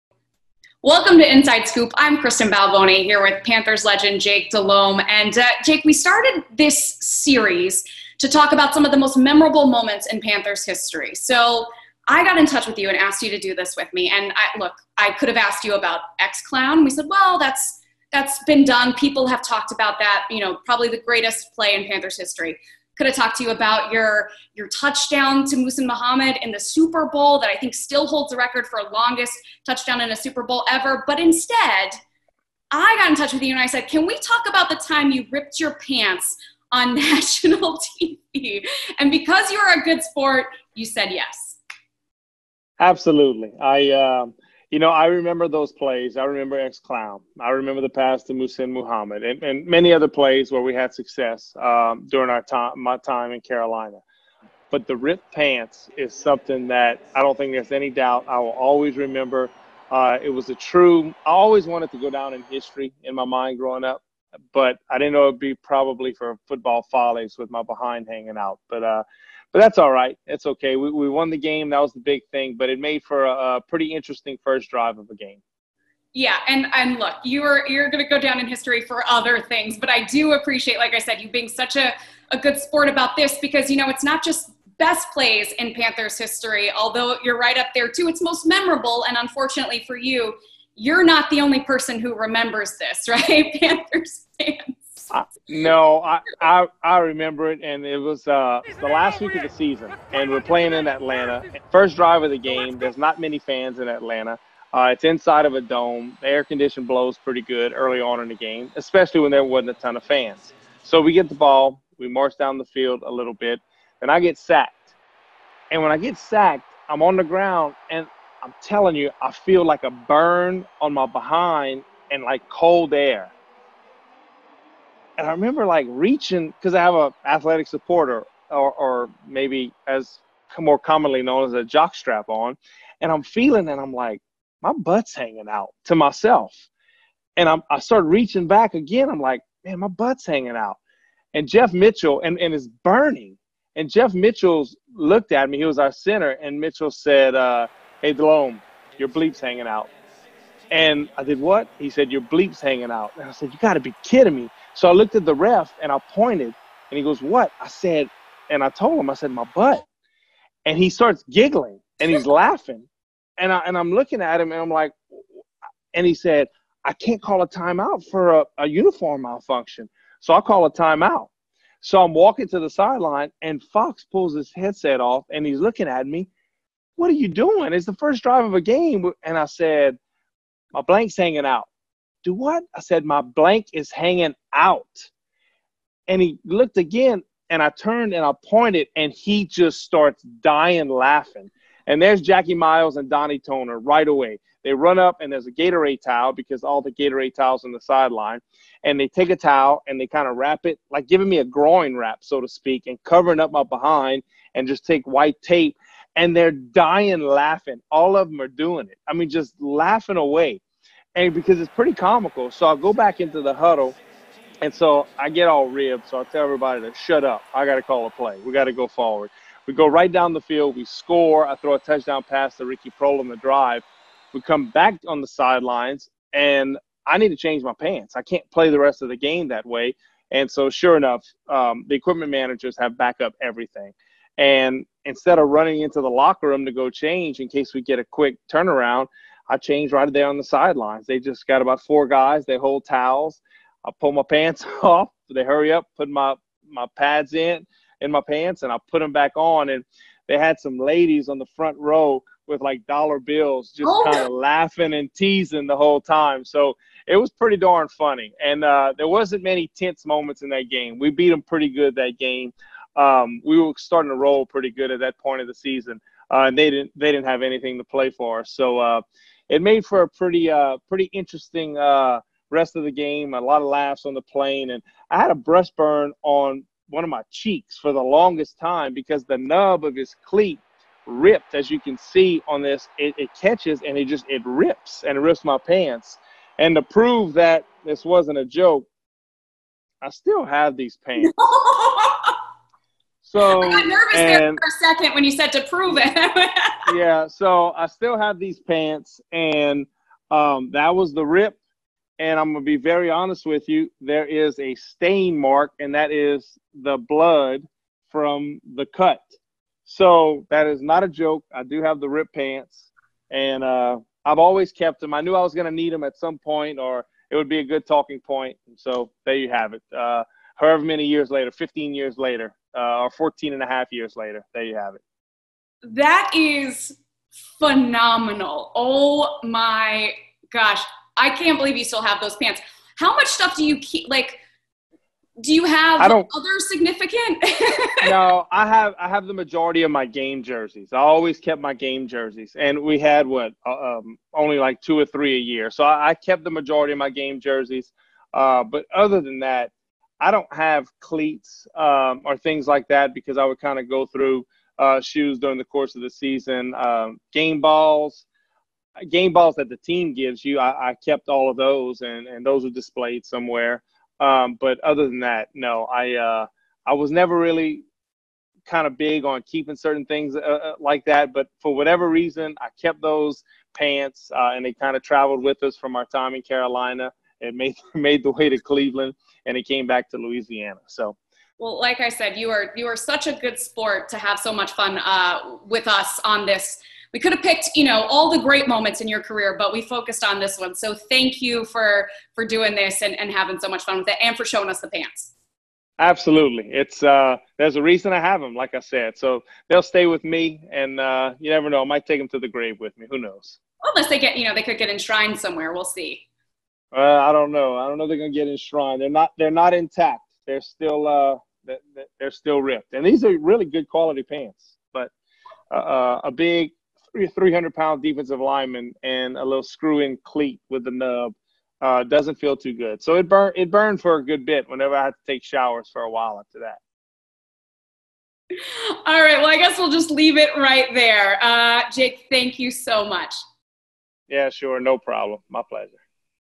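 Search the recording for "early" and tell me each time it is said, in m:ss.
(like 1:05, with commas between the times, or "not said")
1:47.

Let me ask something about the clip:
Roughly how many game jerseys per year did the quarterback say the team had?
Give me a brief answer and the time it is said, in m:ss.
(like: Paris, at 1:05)
2 or 3, at 5:44.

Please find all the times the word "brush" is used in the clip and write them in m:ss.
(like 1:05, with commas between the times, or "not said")
not said.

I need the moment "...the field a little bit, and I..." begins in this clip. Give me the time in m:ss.
1:52.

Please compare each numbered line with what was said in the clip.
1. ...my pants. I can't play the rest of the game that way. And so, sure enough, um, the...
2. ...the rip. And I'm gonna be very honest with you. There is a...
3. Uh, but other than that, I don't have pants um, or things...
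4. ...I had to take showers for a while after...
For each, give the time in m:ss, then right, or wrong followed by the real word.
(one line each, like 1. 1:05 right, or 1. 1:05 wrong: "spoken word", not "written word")
1. 3:47 right
2. 5:01 right
3. 5:48 wrong: "cleats", not "pants"
4. 7:04 right.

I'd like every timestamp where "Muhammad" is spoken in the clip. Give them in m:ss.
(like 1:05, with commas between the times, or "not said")
0:25, 0:48.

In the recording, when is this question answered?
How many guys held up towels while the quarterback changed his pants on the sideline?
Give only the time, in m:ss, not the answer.
4:01.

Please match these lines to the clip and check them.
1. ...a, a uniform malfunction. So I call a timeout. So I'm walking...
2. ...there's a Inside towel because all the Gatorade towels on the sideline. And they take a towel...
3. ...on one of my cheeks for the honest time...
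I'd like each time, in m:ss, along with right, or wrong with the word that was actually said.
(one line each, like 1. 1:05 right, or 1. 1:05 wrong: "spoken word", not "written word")
1. 2:48 right
2. 3:15 wrong: "Gatorade", not "Inside"
3. 4:36 wrong: "longest", not "honest".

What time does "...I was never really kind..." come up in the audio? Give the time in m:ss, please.
6:06.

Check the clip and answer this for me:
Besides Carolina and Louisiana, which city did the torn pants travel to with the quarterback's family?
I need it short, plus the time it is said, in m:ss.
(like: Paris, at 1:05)
Cleveland, at 6:18.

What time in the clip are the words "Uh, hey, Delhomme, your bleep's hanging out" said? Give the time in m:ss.
2:27.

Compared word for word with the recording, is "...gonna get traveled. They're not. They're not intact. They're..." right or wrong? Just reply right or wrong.
wrong.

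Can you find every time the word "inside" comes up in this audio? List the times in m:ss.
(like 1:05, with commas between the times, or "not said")
0:01, 1:45.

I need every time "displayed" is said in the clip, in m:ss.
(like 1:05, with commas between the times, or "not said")
6:02.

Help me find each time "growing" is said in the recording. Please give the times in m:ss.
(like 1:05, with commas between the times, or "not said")
1:03.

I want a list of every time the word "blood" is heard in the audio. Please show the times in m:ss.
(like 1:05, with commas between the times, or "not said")
5:06.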